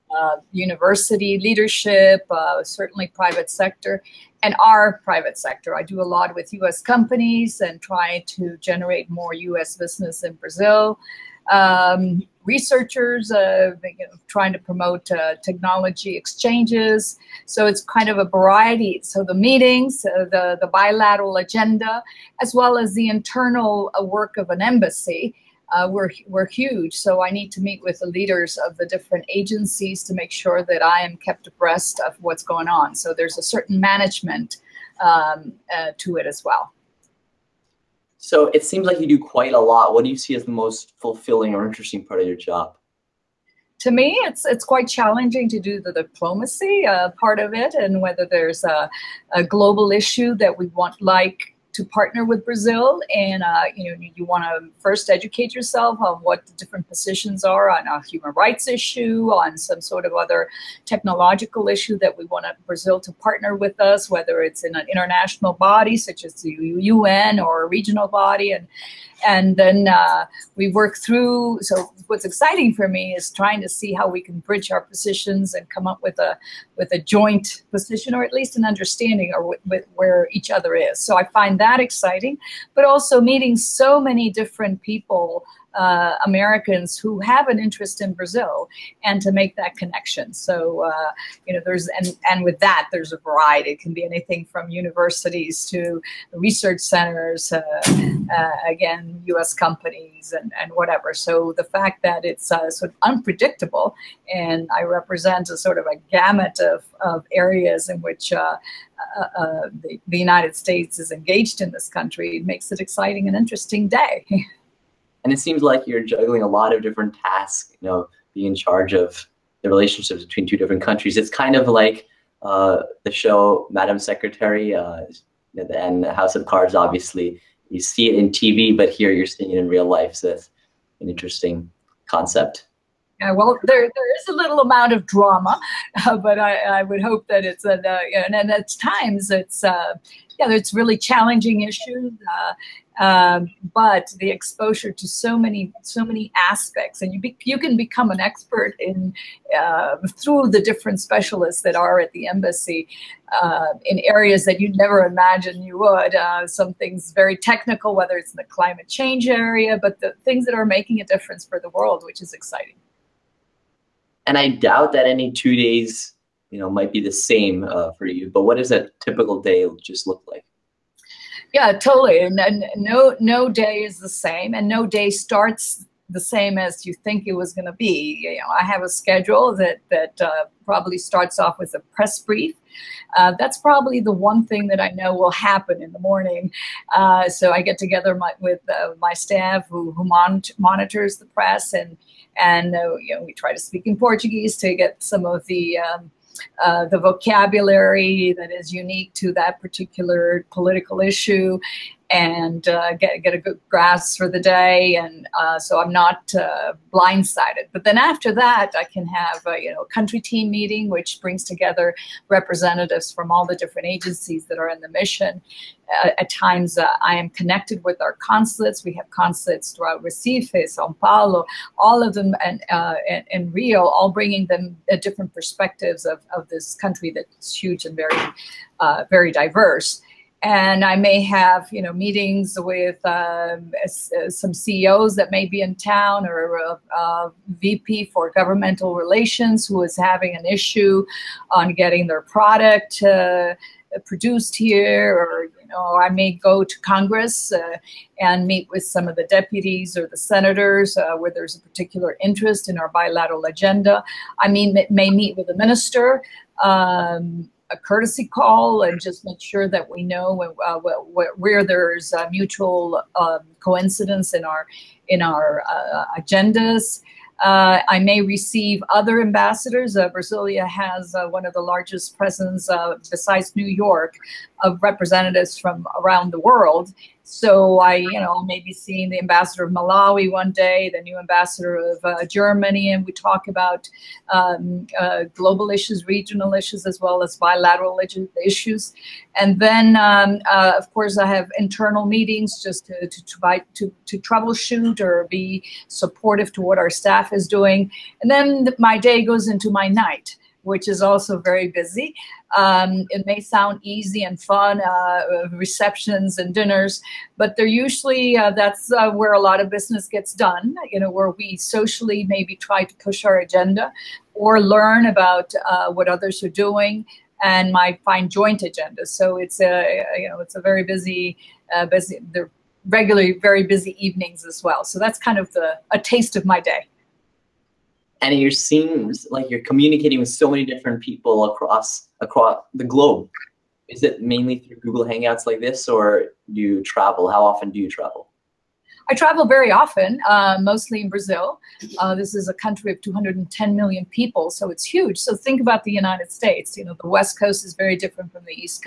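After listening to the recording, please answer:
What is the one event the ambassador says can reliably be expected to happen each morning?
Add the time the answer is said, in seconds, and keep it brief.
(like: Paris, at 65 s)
a press brief, at 181 s.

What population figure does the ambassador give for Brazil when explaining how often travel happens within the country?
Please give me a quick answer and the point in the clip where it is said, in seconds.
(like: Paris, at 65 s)
210 million, at 343 s.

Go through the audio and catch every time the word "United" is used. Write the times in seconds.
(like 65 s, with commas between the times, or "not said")
110 s, 345 s.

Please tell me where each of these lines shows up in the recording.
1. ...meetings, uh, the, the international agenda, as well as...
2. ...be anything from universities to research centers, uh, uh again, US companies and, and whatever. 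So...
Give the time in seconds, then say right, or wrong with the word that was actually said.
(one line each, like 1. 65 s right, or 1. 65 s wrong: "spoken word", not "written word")
1. 19 s wrong: "bilateral", not "international"
2. 93 s right.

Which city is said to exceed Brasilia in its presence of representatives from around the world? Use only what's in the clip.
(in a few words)
New York.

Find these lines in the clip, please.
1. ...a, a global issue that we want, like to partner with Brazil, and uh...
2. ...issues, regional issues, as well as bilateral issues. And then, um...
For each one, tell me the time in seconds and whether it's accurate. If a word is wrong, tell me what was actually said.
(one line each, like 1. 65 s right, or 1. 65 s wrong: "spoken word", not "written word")
1. 48 s right
2. 285 s right.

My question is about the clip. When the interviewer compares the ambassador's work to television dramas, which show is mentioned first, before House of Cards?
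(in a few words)
Madam Secretary.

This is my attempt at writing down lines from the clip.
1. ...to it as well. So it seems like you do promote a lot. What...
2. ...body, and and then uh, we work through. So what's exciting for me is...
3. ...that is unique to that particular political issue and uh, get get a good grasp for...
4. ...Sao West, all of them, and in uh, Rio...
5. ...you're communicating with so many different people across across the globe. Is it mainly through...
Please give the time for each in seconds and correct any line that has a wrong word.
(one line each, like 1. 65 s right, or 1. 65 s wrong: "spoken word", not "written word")
1. 35 s wrong: "quite", not "promote"
2. 68 s right
3. 198 s right
4. 220 s wrong: "Paulo", not "West"
5. 329 s right.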